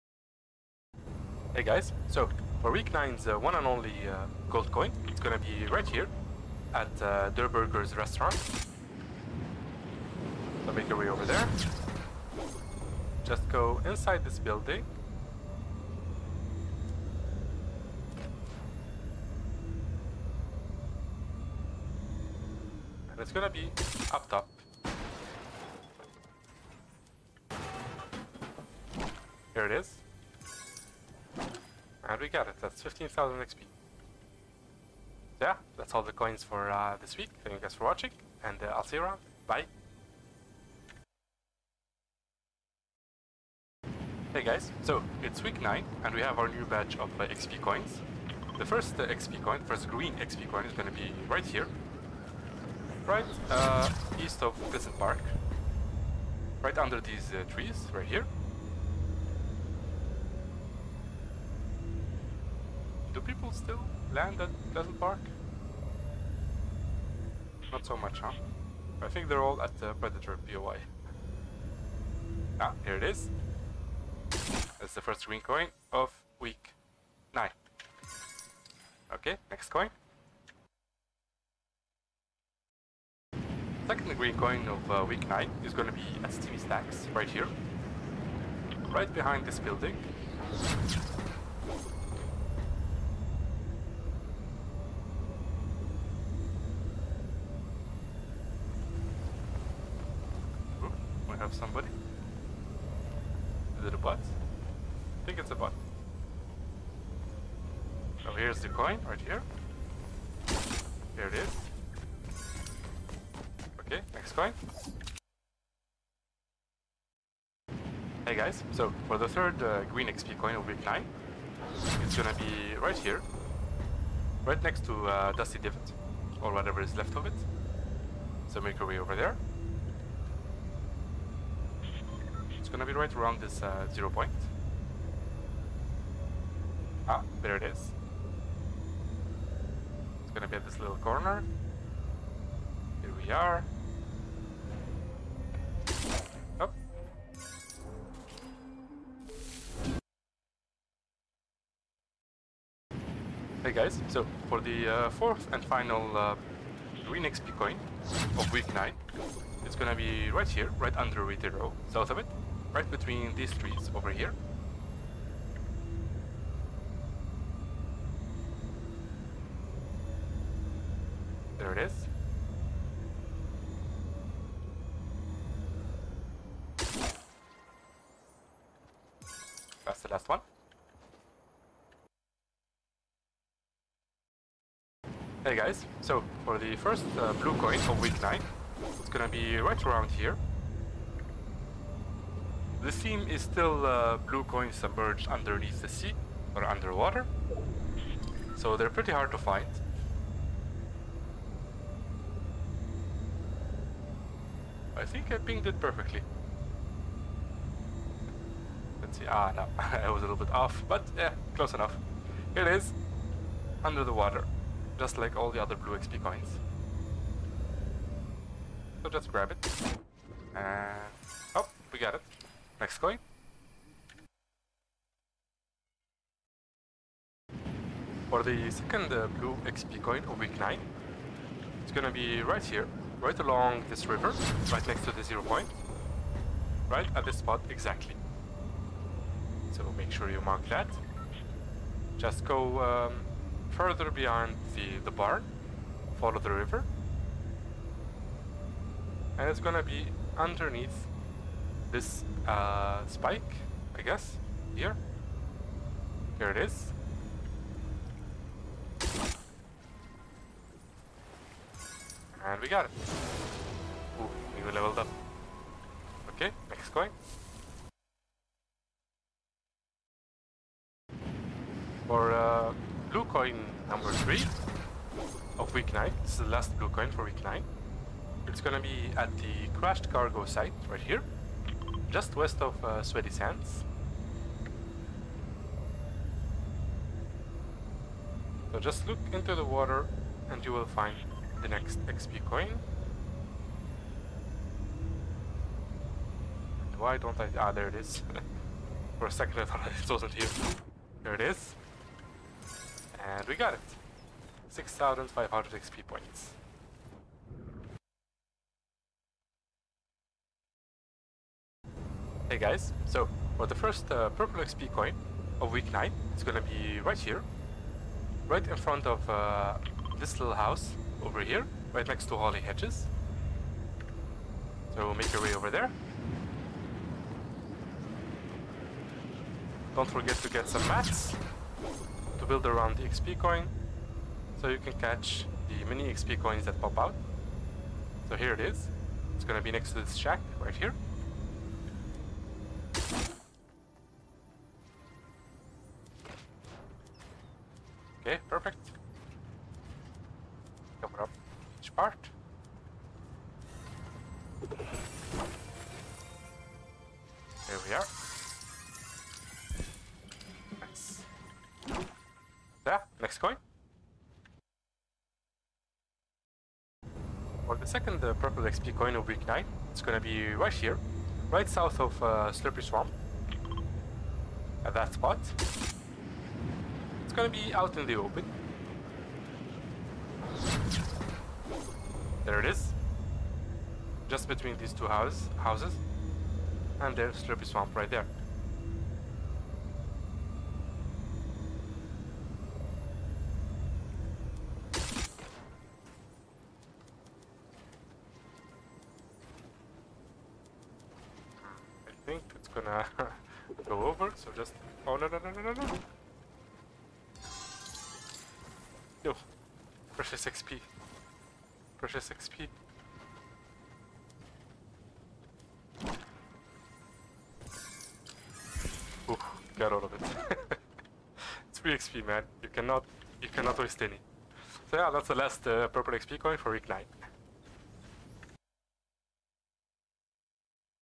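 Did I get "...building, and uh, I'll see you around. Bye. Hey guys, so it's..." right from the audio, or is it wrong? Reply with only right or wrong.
wrong.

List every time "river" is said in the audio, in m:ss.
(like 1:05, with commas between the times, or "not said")
3:54, 4:06.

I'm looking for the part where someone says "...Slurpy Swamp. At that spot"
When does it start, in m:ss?
6:12.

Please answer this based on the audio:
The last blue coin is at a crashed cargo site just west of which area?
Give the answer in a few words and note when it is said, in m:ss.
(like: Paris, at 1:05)
Sweaty Sands, at 4:43.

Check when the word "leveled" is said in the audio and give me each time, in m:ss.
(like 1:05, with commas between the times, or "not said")
4:24.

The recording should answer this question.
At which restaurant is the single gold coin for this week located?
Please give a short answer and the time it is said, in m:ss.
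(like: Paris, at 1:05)
Durr Burger, at 0:07.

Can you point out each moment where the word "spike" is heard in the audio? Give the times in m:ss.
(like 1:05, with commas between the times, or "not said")
4:13.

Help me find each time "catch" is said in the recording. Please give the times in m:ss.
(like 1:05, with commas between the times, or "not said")
5:34.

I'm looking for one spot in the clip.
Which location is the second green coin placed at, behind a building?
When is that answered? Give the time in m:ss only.
1:26.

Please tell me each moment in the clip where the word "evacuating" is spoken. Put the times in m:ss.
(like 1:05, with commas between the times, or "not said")
not said.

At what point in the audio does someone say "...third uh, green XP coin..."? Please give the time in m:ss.
1:59.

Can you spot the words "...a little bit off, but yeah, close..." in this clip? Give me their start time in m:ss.
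3:30.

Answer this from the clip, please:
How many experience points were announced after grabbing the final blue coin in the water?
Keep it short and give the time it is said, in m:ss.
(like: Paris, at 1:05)
6,500, at 5:04.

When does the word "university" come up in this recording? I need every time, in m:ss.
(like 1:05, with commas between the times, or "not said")
not said.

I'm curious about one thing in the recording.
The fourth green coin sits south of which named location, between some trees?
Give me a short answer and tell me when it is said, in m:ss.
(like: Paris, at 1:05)
Retail Row, at 2:41.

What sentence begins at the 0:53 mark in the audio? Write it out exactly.
Right uh, east of Pleasant Park.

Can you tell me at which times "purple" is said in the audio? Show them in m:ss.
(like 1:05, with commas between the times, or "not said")
5:14, 6:08, 7:05.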